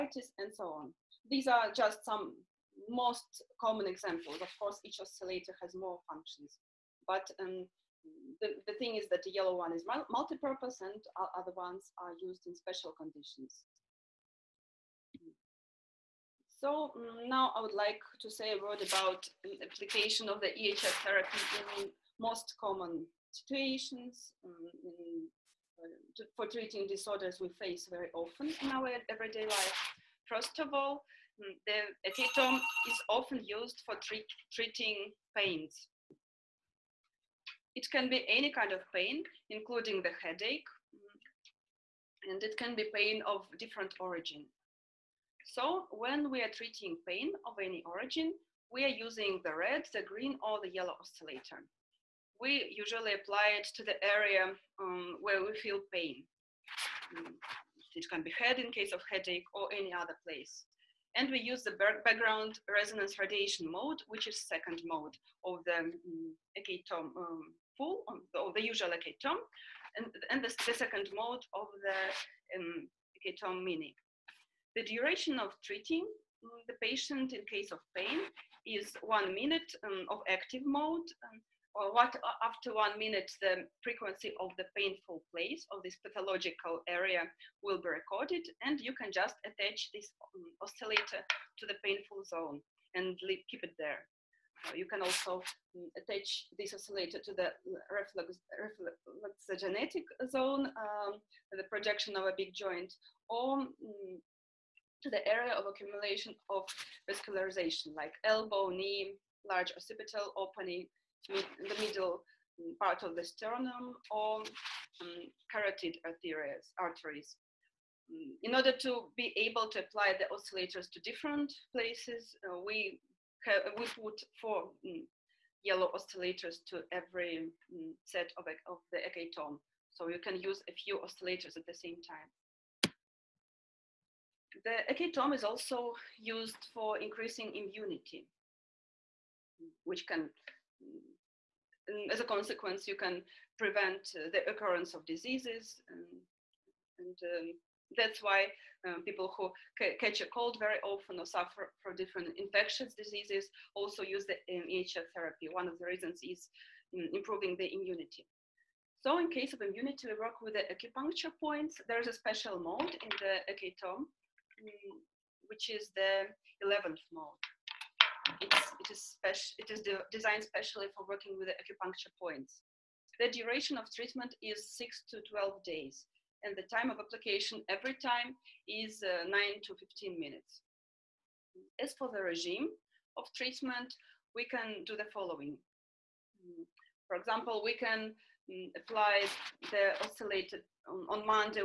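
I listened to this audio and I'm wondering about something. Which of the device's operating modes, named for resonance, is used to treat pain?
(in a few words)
background resonance radiation mode.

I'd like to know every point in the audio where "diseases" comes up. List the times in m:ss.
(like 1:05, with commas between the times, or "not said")
2:25, 2:32.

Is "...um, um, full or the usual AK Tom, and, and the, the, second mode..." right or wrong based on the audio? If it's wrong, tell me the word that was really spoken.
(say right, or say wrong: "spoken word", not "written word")
right.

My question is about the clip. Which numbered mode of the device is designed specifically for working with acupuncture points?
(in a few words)
11th mode.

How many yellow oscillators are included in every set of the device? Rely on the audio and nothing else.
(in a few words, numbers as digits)
4.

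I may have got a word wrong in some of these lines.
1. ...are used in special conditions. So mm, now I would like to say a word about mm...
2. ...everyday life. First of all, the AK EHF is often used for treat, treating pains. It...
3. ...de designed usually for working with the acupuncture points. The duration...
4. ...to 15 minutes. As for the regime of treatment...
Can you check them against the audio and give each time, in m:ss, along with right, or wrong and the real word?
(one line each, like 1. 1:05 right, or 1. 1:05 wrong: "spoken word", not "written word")
1. 0:11 right
2. 0:29 wrong: "Tom", not "EHF"
3. 2:49 wrong: "specially", not "usually"
4. 2:59 right.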